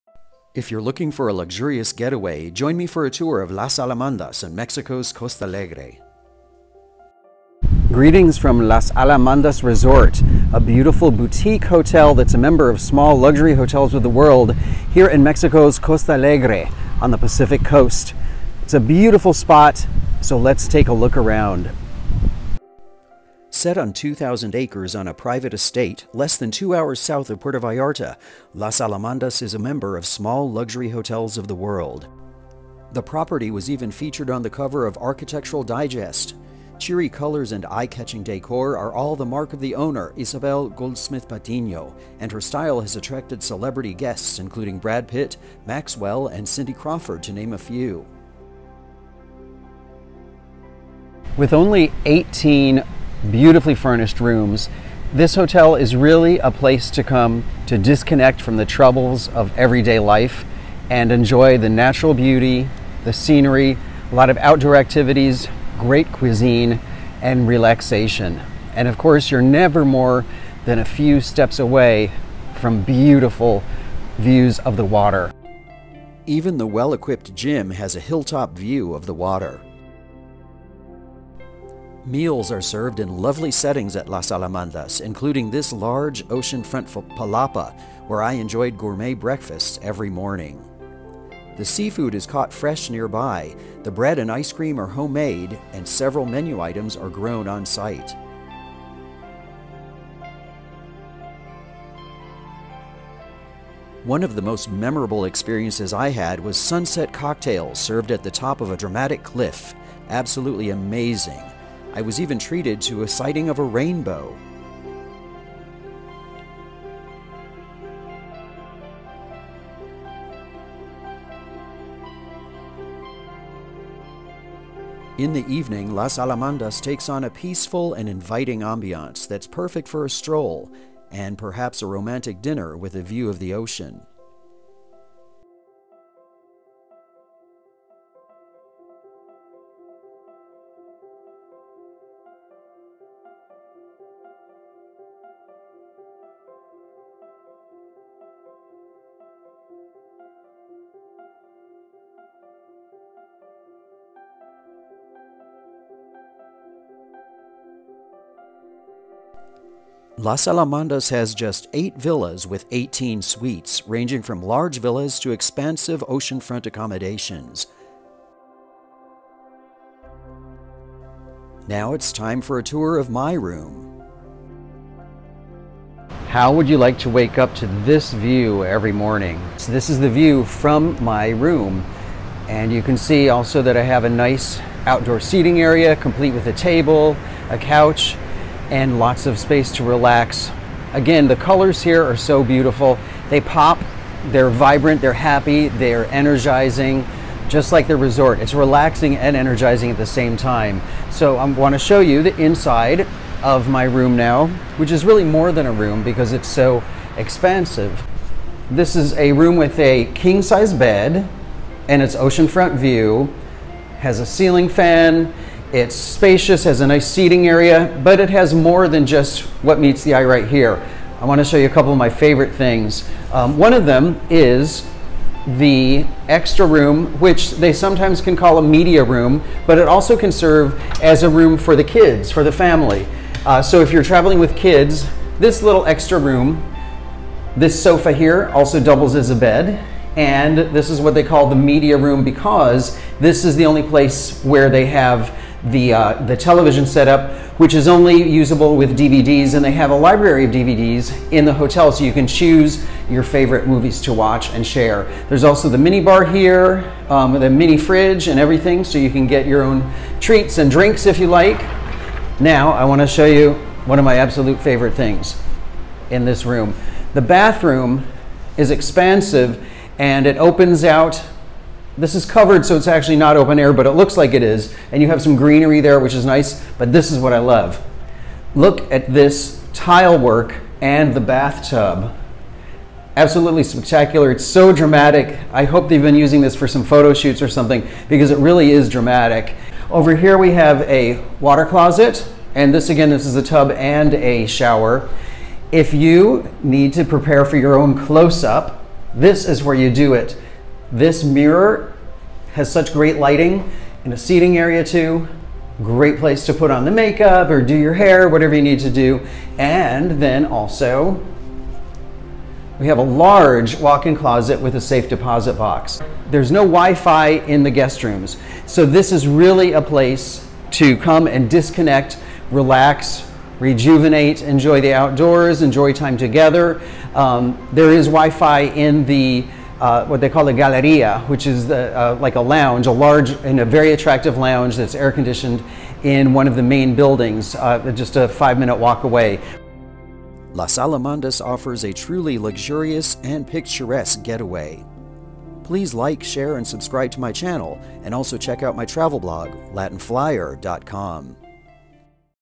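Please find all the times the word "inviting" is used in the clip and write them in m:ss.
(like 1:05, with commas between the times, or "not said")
2:08.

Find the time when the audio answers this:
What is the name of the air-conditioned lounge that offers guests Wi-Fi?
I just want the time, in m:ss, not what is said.
5:30.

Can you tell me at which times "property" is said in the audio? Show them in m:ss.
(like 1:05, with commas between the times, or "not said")
0:33.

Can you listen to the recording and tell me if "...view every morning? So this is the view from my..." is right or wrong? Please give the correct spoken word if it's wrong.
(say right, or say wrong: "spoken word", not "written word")
right.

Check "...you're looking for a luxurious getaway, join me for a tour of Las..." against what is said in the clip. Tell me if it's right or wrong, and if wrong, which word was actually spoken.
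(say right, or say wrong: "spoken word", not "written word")
right.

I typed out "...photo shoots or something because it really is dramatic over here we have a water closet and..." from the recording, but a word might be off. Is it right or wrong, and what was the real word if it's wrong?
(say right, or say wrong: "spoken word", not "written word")
right.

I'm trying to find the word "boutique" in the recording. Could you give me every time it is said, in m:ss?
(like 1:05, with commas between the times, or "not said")
0:11.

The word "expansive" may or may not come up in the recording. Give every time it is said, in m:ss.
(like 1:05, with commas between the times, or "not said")
2:45, 3:27, 4:28.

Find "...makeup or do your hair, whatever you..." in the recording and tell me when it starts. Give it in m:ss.
5:06.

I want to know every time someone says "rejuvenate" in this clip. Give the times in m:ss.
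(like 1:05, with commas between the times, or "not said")
5:23.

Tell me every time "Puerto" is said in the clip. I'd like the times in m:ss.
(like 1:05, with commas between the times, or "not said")
0:27.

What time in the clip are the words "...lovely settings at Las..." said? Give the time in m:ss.
1:23.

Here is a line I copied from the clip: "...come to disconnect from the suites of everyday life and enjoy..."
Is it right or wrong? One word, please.
wrong.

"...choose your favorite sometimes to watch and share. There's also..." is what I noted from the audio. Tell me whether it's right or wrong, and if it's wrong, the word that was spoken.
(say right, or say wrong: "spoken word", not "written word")
wrong: "movies", not "sometimes".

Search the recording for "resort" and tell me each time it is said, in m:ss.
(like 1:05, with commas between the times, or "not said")
0:09, 3:17.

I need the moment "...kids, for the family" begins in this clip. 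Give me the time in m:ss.
3:51.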